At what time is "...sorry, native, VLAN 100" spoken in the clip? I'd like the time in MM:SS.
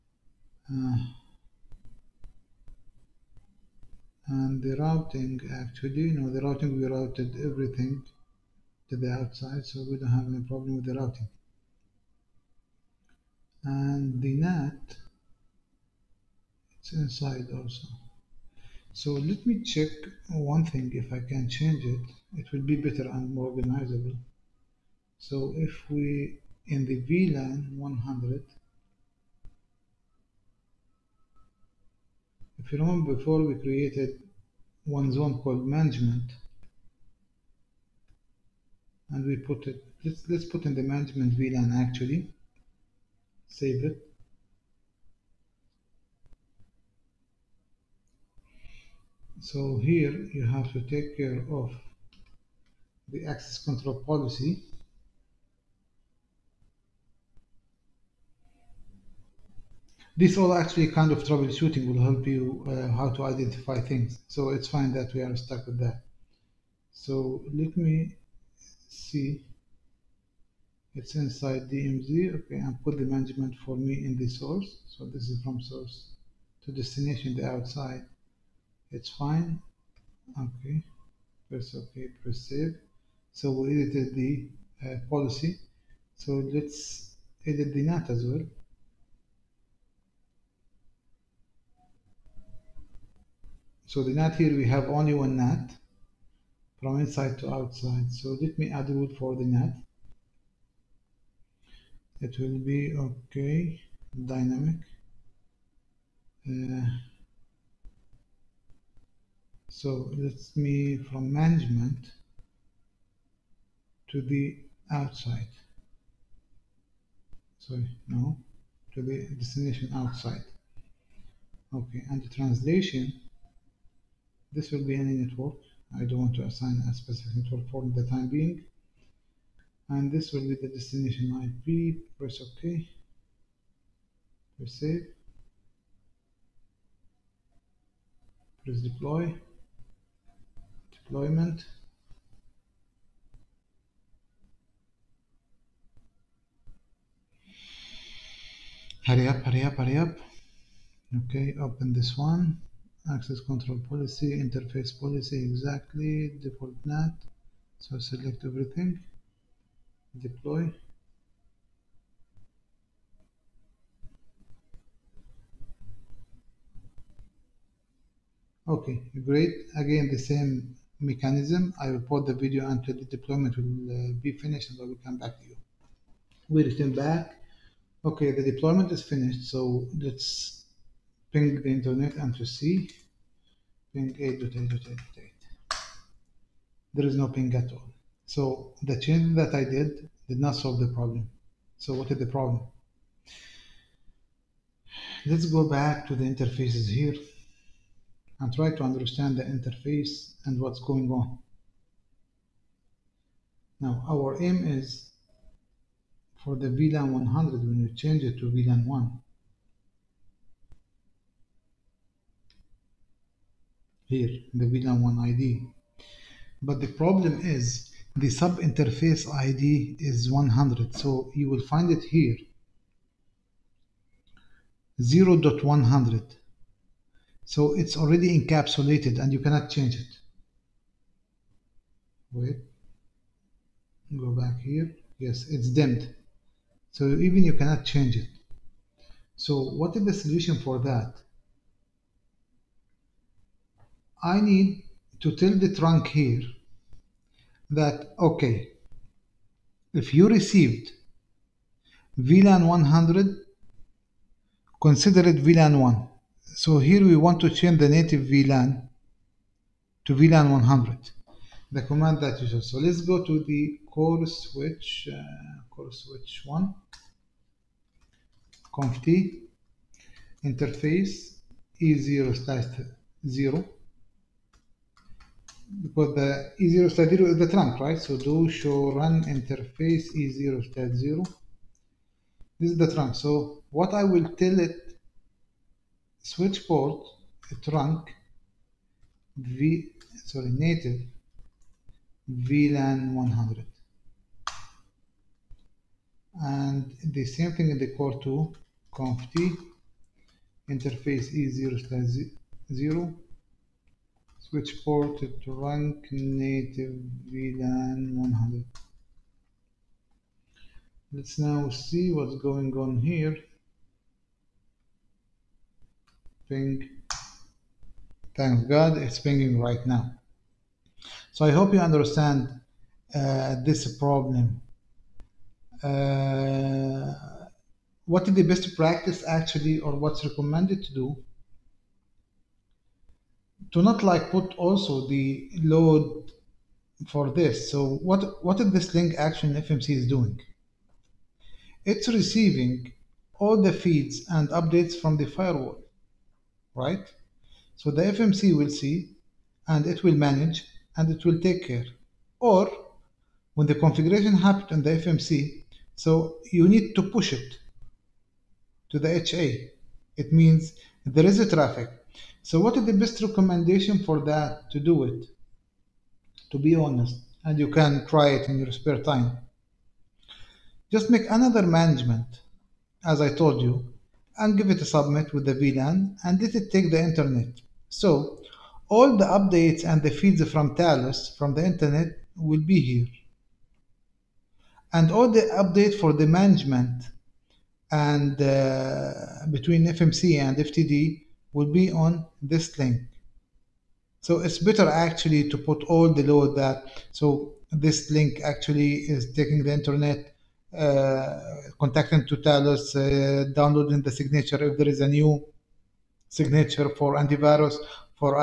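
04:50.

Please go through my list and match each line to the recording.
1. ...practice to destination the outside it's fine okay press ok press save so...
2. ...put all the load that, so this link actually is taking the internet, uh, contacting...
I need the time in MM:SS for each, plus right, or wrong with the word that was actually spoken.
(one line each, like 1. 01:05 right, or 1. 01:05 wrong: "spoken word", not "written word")
1. 01:15 wrong: "source", not "practice"
2. 06:35 right.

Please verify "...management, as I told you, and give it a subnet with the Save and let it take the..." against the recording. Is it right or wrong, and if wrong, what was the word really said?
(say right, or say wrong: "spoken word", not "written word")
wrong: "VLAN", not "Save".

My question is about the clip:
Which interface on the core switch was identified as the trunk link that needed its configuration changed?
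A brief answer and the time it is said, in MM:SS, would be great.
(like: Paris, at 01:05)
E0/0, at 04:31.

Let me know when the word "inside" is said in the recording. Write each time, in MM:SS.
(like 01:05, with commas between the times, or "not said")
00:16, 01:11, 01:36.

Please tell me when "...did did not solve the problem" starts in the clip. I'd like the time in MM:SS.
03:09.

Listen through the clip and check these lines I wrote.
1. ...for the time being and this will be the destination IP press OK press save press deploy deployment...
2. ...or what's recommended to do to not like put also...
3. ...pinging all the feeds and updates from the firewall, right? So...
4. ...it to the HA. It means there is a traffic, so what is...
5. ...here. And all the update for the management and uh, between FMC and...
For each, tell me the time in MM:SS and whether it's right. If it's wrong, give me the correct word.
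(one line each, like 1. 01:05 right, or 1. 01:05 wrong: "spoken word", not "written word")
1. 02:07 right
2. 05:29 right
3. 05:42 wrong: "receiving", not "pinging"
4. 05:57 right
5. 06:22 right.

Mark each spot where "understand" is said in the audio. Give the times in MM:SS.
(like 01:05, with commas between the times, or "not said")
03:18, 05:21.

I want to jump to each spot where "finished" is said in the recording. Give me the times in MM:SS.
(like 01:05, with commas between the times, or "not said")
02:54, 02:59.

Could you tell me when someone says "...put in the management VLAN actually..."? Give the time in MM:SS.
00:40.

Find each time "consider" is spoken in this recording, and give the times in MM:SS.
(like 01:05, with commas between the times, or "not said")
04:14.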